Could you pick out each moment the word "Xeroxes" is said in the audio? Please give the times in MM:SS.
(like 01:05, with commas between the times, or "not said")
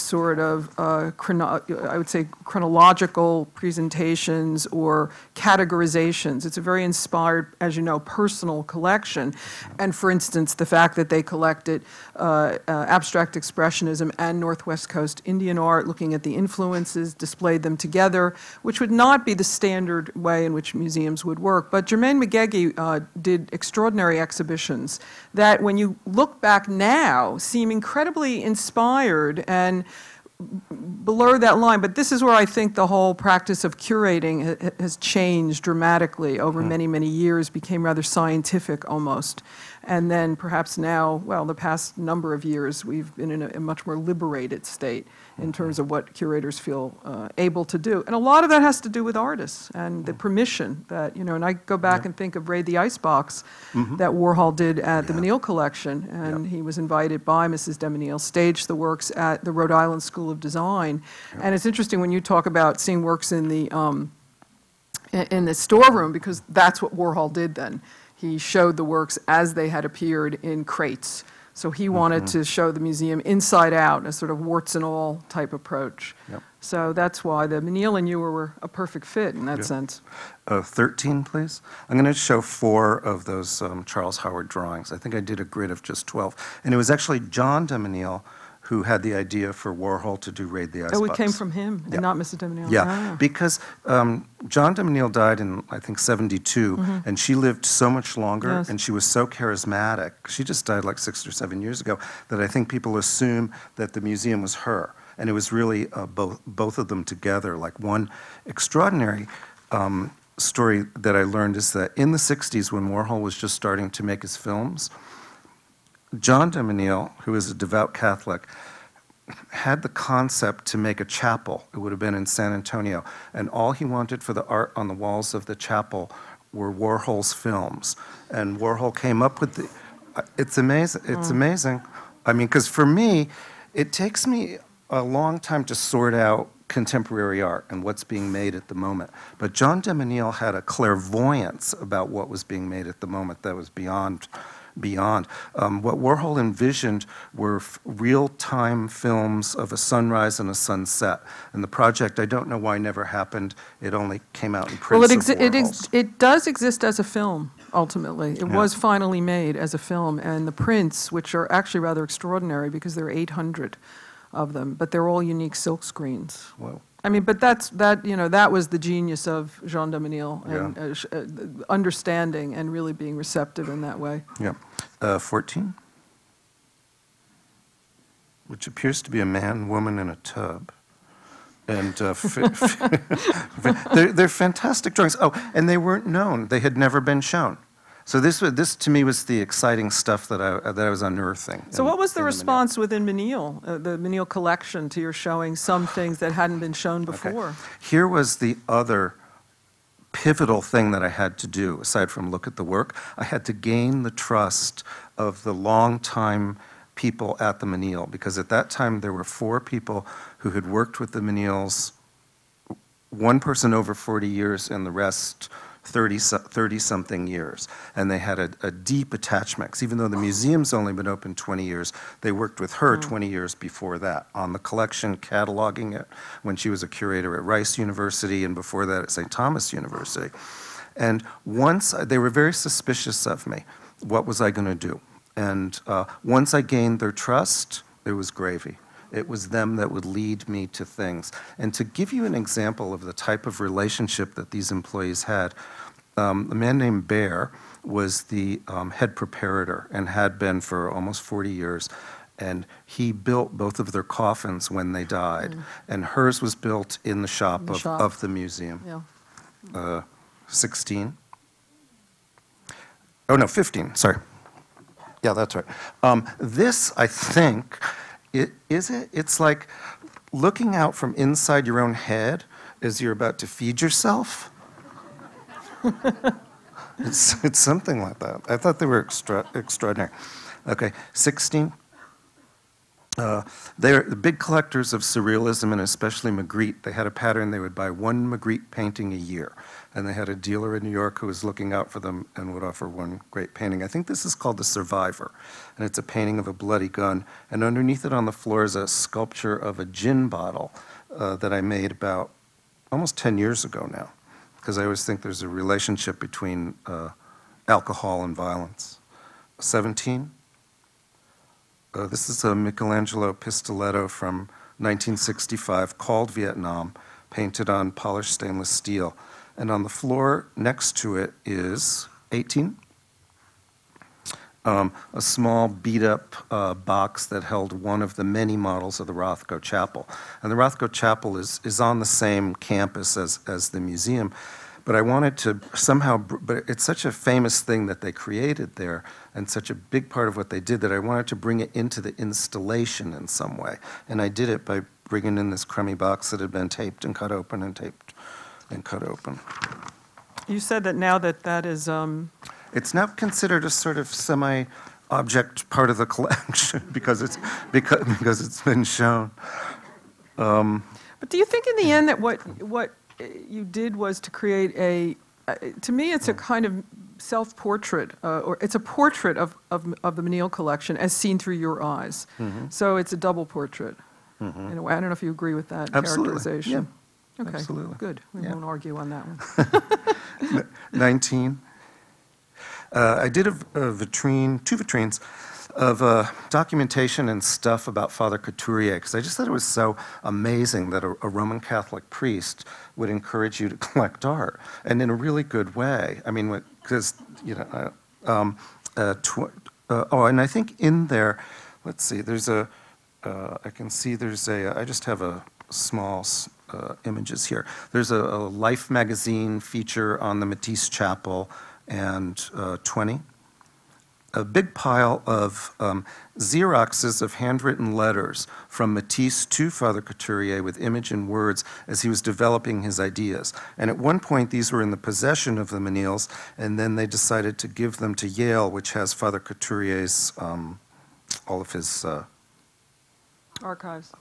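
06:56.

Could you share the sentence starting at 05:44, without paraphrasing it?
And I did it by bringing in this crummy box that had been taped and cut open and taped and cut open.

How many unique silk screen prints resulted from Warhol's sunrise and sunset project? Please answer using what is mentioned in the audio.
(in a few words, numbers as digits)
800.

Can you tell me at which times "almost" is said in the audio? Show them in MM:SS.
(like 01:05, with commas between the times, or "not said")
00:38, 04:10, 05:02.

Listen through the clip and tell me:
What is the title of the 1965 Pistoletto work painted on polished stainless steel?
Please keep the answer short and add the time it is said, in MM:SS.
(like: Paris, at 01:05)
Vietnam, at 05:16.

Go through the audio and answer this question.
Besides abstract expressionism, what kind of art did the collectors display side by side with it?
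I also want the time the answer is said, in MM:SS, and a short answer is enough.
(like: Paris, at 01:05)
Northwest Coast Indian art, at 00:14.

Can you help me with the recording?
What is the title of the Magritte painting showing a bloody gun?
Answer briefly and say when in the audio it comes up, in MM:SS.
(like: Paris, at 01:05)
The Survivor, at 04:54.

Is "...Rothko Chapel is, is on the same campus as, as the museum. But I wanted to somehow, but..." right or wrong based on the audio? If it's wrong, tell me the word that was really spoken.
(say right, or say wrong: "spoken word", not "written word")
right.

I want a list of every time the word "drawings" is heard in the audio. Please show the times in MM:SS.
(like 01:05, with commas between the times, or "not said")
01:24, 03:04.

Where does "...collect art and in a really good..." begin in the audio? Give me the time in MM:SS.
06:33.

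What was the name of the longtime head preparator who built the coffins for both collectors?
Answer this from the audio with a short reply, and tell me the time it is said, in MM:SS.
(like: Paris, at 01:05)
Bear, at 04:07.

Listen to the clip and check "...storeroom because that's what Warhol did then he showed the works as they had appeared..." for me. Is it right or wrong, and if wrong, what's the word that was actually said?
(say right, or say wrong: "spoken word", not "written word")
right.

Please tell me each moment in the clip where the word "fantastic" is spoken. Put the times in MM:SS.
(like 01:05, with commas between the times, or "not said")
03:04.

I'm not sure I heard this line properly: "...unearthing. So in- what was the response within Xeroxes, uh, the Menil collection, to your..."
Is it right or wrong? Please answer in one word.
wrong.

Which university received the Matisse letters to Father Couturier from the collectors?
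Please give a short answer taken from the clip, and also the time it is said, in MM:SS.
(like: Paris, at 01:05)
Yale, at 07:08.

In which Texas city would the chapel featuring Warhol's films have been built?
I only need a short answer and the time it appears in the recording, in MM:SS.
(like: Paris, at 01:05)
San Antonio, at 02:02.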